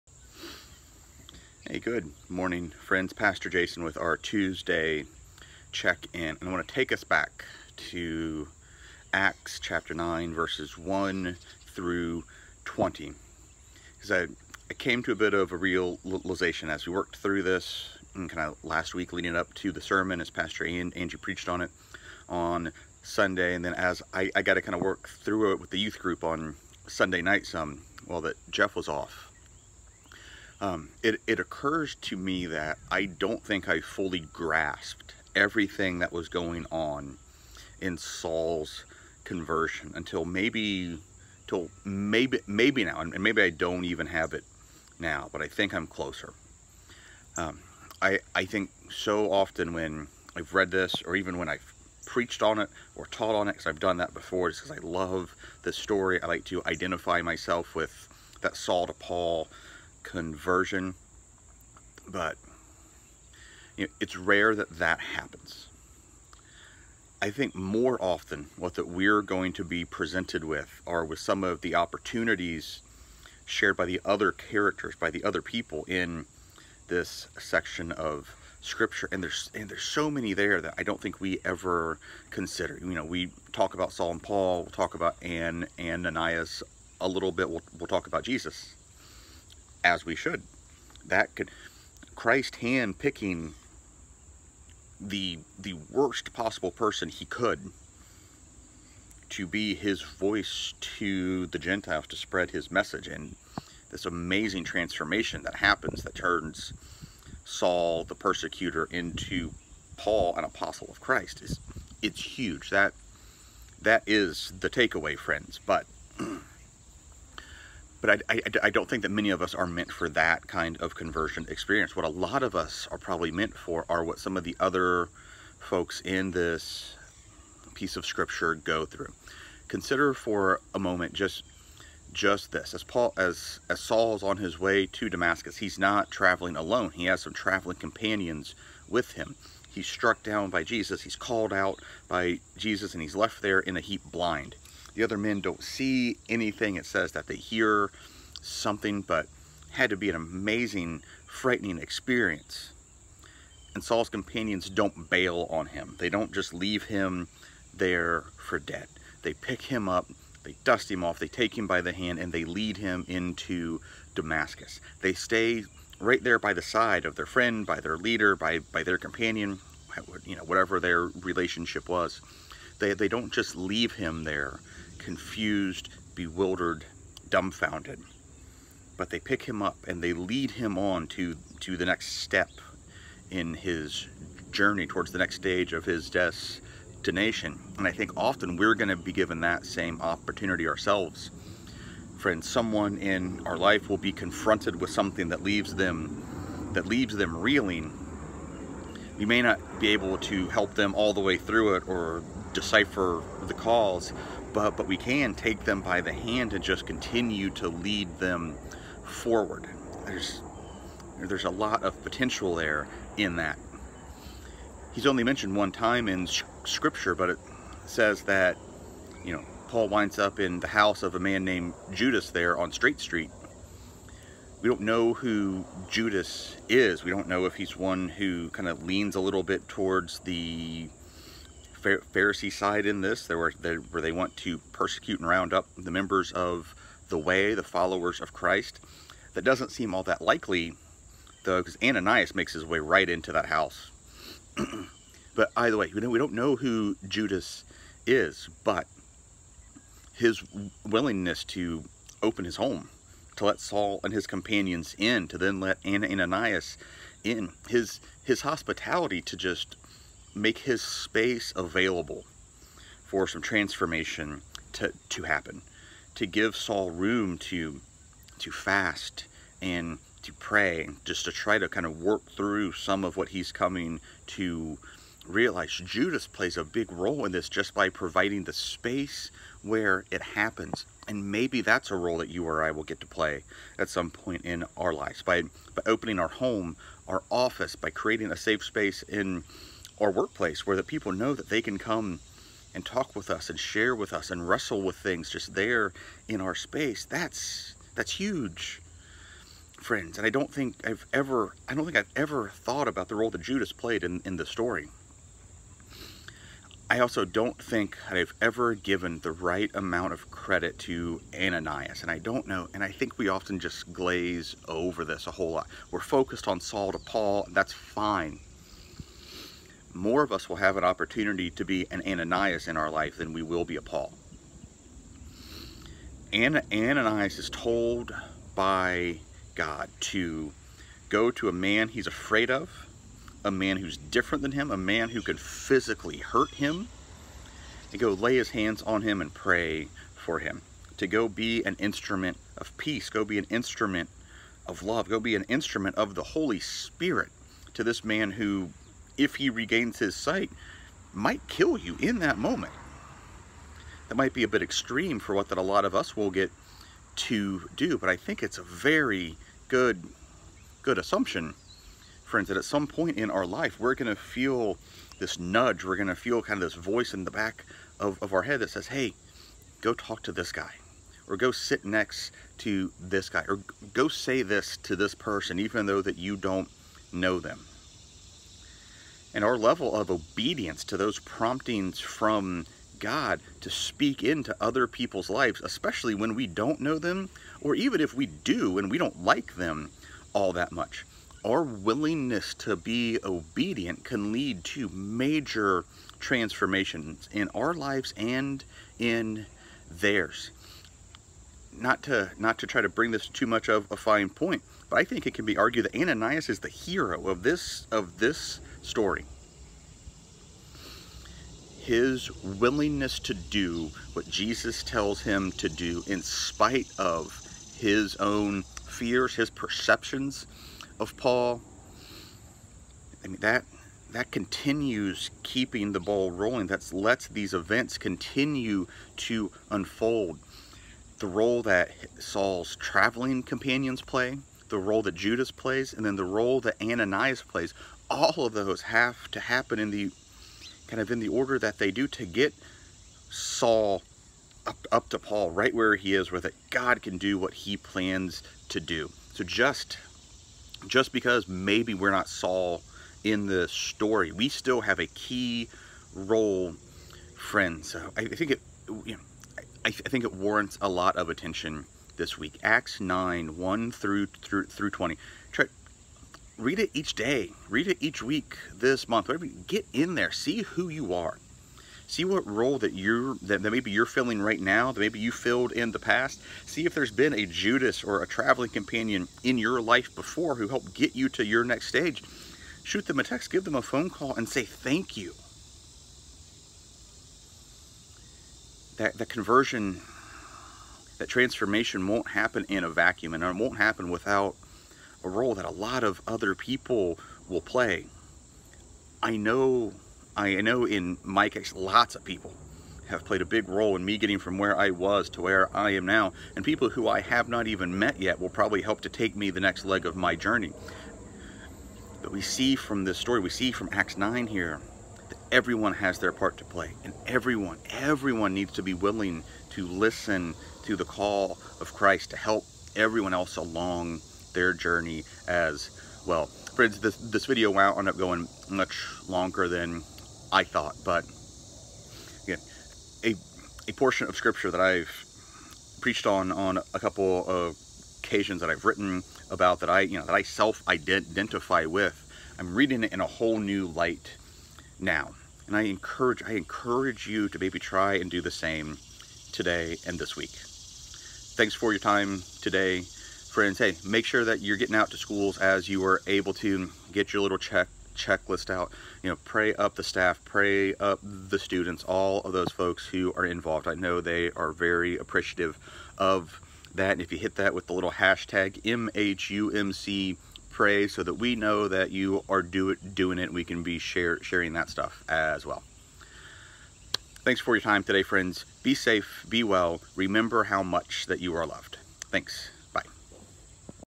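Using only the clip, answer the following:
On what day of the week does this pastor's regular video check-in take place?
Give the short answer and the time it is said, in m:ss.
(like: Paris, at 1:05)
Tuesday, at 0:04.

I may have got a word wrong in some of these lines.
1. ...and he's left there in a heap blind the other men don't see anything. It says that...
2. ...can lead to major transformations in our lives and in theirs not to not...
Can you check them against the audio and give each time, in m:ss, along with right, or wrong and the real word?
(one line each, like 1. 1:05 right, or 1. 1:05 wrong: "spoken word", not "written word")
1. 2:22 right
2. 6:34 right.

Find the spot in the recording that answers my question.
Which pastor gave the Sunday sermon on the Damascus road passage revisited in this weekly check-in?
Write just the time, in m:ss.
0:20.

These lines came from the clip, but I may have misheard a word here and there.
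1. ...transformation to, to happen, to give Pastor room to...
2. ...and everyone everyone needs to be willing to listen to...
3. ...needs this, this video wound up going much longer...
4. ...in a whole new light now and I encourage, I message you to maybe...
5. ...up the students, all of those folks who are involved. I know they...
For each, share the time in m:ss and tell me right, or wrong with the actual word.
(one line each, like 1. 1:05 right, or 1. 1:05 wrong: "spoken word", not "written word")
1. 4:23 wrong: "Saul", not "Pastor"
2. 8:37 right
3. 8:46 wrong: "friends", not "needs"
4. 9:03 wrong: "encourage", not "message"
5. 9:20 right.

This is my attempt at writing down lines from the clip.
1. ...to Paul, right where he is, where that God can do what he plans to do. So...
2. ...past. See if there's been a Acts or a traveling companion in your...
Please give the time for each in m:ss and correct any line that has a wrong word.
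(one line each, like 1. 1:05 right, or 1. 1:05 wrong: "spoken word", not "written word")
1. 7:25 right
2. 7:55 wrong: "Judas", not "Acts".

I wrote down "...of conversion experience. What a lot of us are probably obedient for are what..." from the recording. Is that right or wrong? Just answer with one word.
wrong.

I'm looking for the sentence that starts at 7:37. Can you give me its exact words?
So I think it you know, I, th I, think it warrants a lot of attention this week.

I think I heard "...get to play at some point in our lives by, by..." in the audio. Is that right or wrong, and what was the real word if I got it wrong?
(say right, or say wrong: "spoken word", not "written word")
right.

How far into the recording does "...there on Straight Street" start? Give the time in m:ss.
3:42.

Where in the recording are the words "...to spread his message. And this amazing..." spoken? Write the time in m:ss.
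1:42.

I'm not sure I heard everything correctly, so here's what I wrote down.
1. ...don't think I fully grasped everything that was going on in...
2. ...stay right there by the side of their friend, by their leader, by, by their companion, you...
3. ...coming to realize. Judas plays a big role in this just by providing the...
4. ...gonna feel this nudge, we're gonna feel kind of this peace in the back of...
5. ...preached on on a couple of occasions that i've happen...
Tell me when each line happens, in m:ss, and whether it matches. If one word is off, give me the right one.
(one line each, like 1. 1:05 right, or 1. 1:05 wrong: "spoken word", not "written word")
1. 0:33 right
2. 2:45 right
3. 4:33 right
4. 6:03 wrong: "voice", not "peace"
5. 8:55 wrong: "written", not "happen".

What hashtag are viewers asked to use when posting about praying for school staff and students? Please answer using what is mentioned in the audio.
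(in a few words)
#MHUMC pray.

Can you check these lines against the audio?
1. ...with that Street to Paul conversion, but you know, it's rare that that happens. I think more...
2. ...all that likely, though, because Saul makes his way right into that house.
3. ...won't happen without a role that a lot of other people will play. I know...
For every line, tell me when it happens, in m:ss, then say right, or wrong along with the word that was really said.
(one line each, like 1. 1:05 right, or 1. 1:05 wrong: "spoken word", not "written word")
1. 0:57 wrong: "Saul", not "Street"
2. 3:59 wrong: "Ananias", not "Saul"
3. 8:13 right.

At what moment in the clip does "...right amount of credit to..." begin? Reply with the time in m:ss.
5:09.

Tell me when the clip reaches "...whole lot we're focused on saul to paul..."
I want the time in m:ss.
5:15.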